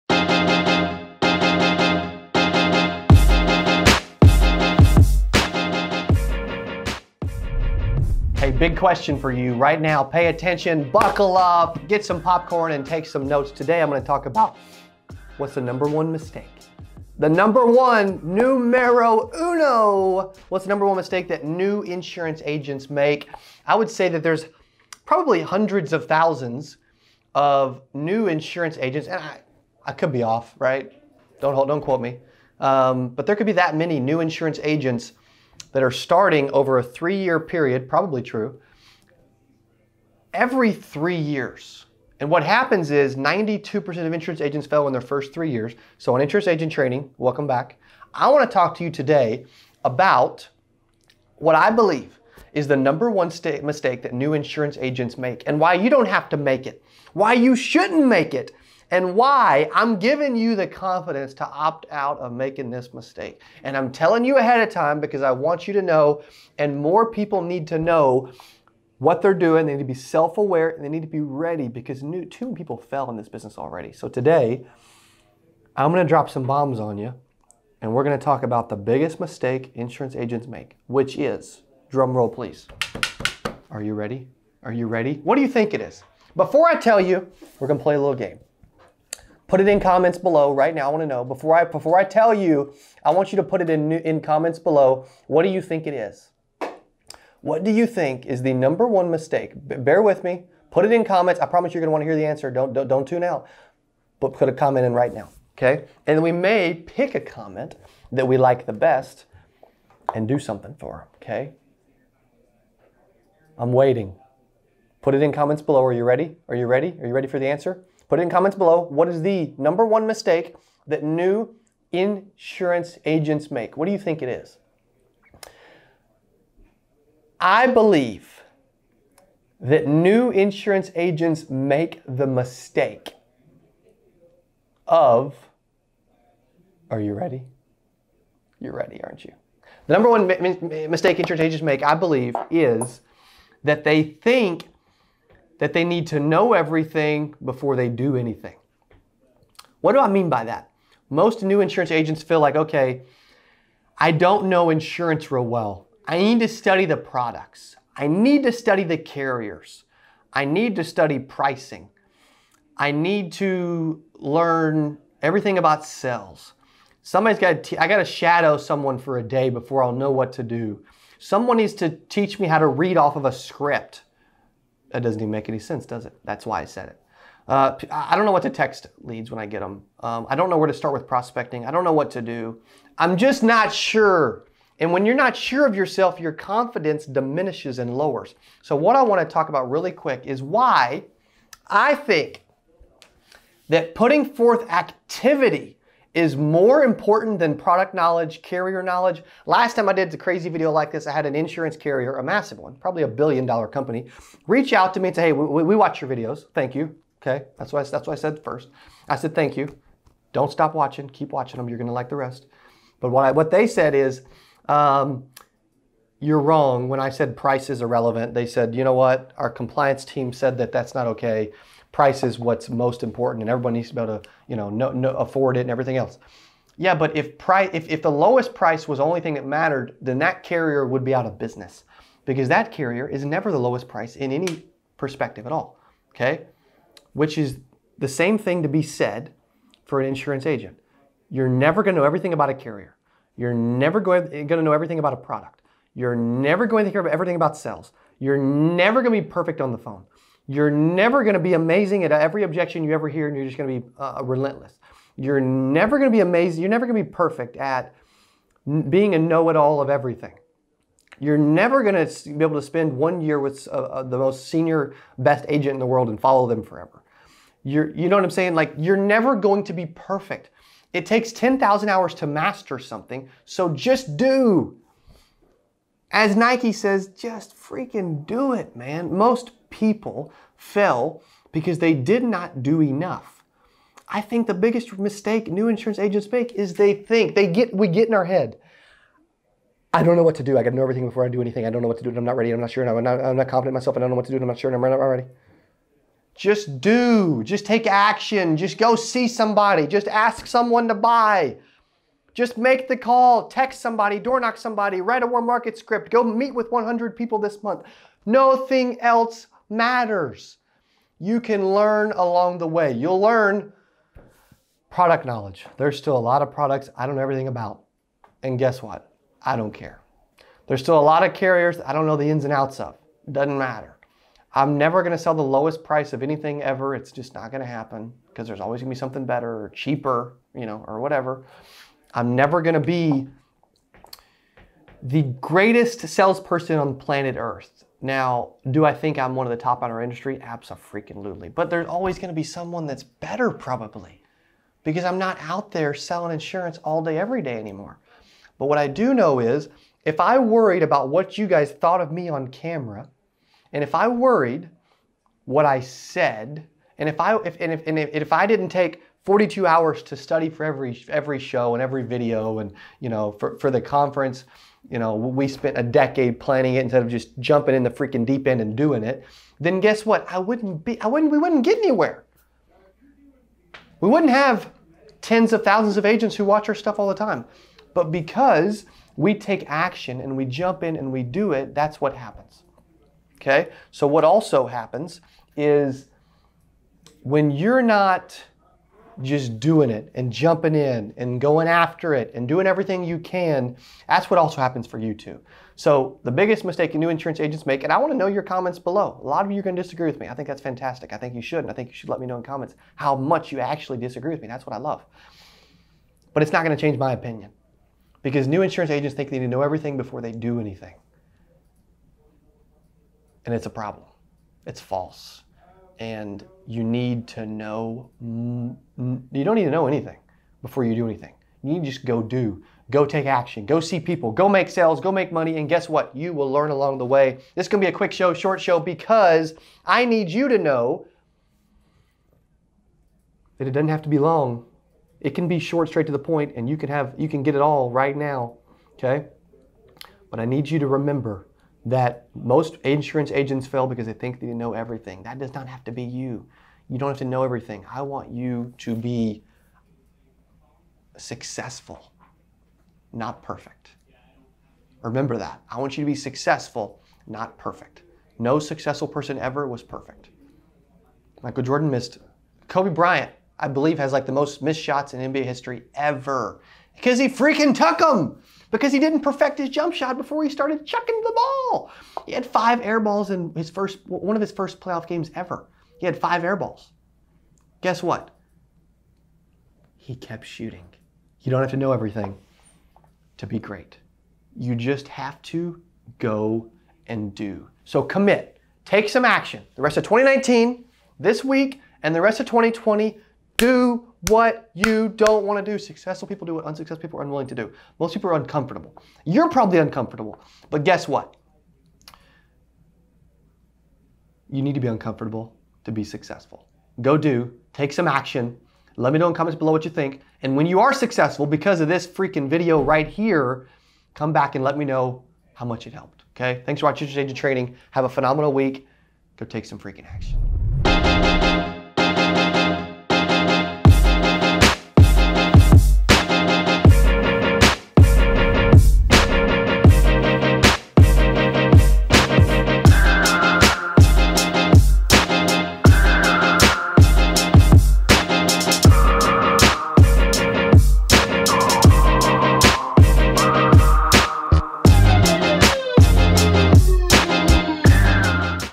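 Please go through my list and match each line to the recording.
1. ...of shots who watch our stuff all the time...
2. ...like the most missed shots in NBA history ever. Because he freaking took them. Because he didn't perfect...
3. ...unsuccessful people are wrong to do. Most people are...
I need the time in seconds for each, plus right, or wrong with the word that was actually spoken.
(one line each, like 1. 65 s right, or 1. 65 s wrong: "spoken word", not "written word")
1. 375 s wrong: "agents", not "shots"
2. 464 s right
3. 496 s wrong: "unwilling", not "wrong".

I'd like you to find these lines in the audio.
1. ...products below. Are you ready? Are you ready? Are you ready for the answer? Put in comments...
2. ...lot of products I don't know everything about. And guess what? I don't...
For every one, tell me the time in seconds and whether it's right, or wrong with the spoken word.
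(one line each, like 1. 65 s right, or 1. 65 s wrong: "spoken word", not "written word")
1. 115 s wrong: "comments", not "products"
2. 316 s right.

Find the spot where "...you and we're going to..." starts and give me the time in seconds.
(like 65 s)
76 s.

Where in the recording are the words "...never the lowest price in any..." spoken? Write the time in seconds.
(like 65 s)
233 s.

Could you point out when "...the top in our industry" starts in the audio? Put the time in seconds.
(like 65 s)
339 s.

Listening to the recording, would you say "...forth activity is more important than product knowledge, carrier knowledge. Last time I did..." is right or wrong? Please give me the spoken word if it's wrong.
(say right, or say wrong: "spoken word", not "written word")
right.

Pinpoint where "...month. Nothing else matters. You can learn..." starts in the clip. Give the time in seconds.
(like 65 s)
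307 s.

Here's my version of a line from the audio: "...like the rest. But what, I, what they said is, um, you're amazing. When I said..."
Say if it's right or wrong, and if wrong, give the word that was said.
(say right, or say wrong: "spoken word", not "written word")
wrong: "wrong", not "amazing".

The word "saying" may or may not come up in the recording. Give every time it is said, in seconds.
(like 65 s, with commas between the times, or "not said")
268 s.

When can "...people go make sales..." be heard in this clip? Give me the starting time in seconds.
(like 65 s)
423 s.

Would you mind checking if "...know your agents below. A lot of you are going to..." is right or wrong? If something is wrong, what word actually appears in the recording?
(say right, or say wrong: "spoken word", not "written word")
wrong: "comments", not "agents".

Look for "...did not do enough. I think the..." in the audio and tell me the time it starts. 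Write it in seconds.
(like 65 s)
281 s.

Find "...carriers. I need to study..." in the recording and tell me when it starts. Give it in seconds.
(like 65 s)
158 s.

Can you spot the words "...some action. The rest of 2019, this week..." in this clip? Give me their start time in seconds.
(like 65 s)
489 s.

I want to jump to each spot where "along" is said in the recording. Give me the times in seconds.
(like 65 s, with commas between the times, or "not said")
312 s, 426 s.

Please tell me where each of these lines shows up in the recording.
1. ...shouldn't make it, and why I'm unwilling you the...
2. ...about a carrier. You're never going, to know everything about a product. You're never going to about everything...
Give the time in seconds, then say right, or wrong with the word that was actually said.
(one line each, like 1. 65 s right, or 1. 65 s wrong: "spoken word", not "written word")
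1. 57 s wrong: "giving", not "unwilling"
2. 242 s right.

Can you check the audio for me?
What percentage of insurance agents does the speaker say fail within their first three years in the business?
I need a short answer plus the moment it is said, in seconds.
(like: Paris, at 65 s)
92%, at 43 s.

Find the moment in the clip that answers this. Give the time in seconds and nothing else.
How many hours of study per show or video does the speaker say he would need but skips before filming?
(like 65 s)
359 s.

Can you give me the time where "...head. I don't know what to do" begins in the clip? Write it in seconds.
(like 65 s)
288 s.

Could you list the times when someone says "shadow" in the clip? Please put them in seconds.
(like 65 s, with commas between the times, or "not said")
168 s.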